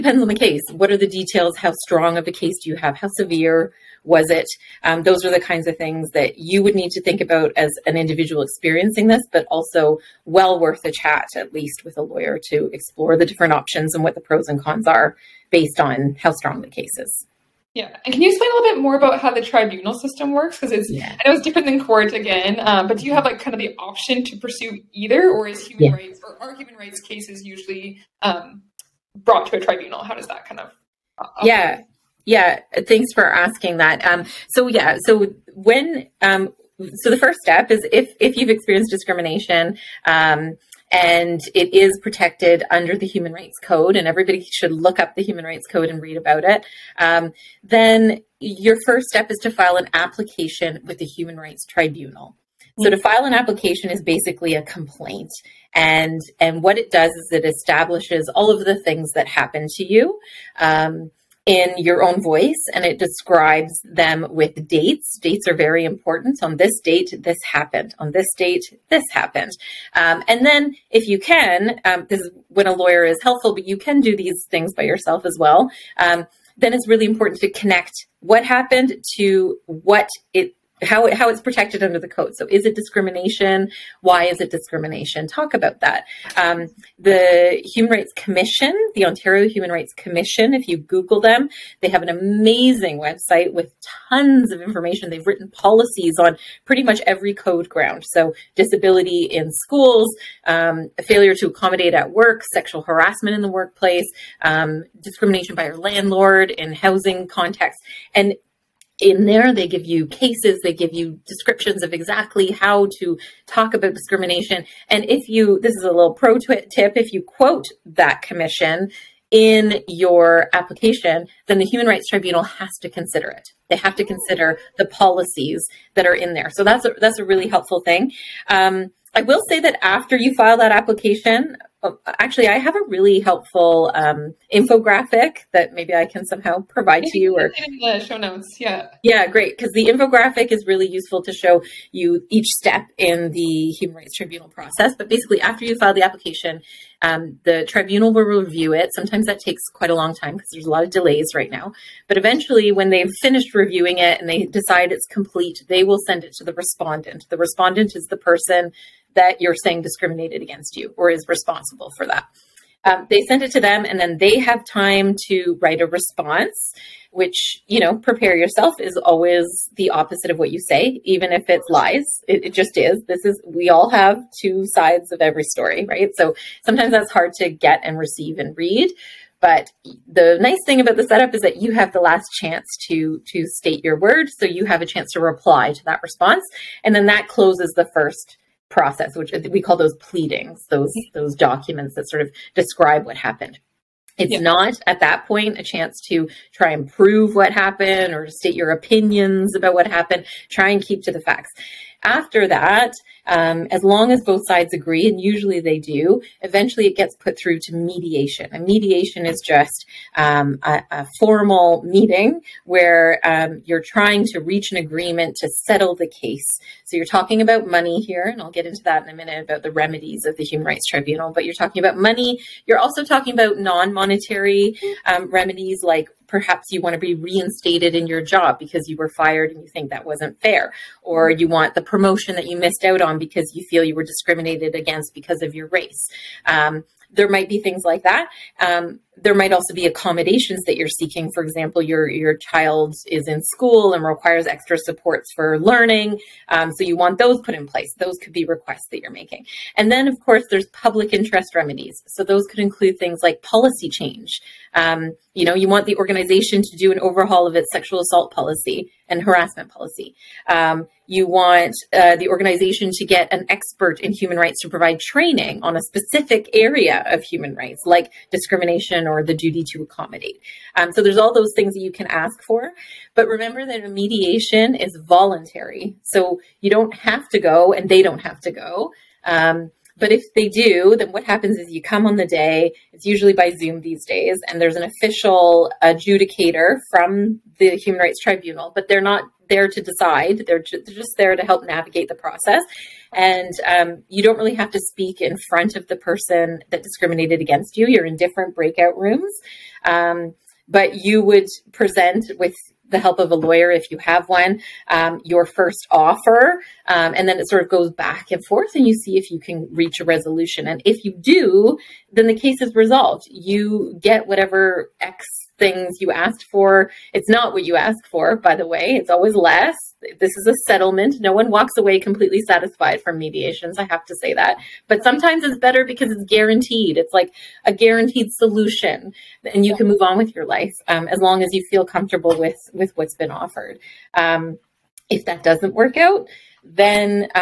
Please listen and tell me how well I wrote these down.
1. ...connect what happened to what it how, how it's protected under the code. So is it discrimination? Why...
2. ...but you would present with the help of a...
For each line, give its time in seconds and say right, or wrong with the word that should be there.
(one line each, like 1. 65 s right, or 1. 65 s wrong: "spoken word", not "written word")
1. 77 s right
2. 300 s right.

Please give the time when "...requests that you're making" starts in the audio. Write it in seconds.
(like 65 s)
248 s.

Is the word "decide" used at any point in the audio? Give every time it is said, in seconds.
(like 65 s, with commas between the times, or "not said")
154 s, 289 s.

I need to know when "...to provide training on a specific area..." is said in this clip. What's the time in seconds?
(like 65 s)
264 s.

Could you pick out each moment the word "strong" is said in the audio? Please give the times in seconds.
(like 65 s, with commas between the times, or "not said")
1 s, 16 s.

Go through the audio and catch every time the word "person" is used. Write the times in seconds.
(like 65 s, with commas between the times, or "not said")
158 s, 295 s.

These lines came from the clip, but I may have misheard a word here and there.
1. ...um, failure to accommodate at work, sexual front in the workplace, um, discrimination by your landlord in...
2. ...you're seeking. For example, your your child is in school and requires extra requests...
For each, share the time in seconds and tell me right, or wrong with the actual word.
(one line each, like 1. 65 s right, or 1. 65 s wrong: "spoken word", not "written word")
1. 100 s wrong: "harassment", not "front"
2. 240 s wrong: "supports", not "requests".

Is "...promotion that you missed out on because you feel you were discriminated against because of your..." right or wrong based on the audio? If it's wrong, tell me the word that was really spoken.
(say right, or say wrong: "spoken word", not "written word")
right.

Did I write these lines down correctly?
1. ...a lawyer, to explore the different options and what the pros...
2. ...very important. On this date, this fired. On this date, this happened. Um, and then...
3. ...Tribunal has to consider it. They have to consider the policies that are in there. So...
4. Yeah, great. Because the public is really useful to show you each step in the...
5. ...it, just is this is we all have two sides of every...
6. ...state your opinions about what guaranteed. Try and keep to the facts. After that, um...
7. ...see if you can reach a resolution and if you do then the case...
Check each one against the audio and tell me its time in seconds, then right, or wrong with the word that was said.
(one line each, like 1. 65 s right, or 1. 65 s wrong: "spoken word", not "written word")
1. 11 s right
2. 65 s wrong: "happened", not "fired"
3. 122 s right
4. 139 s wrong: "infographic", not "public"
5. 172 s right
6. 198 s wrong: "happened", not "guaranteed"
7. 308 s right.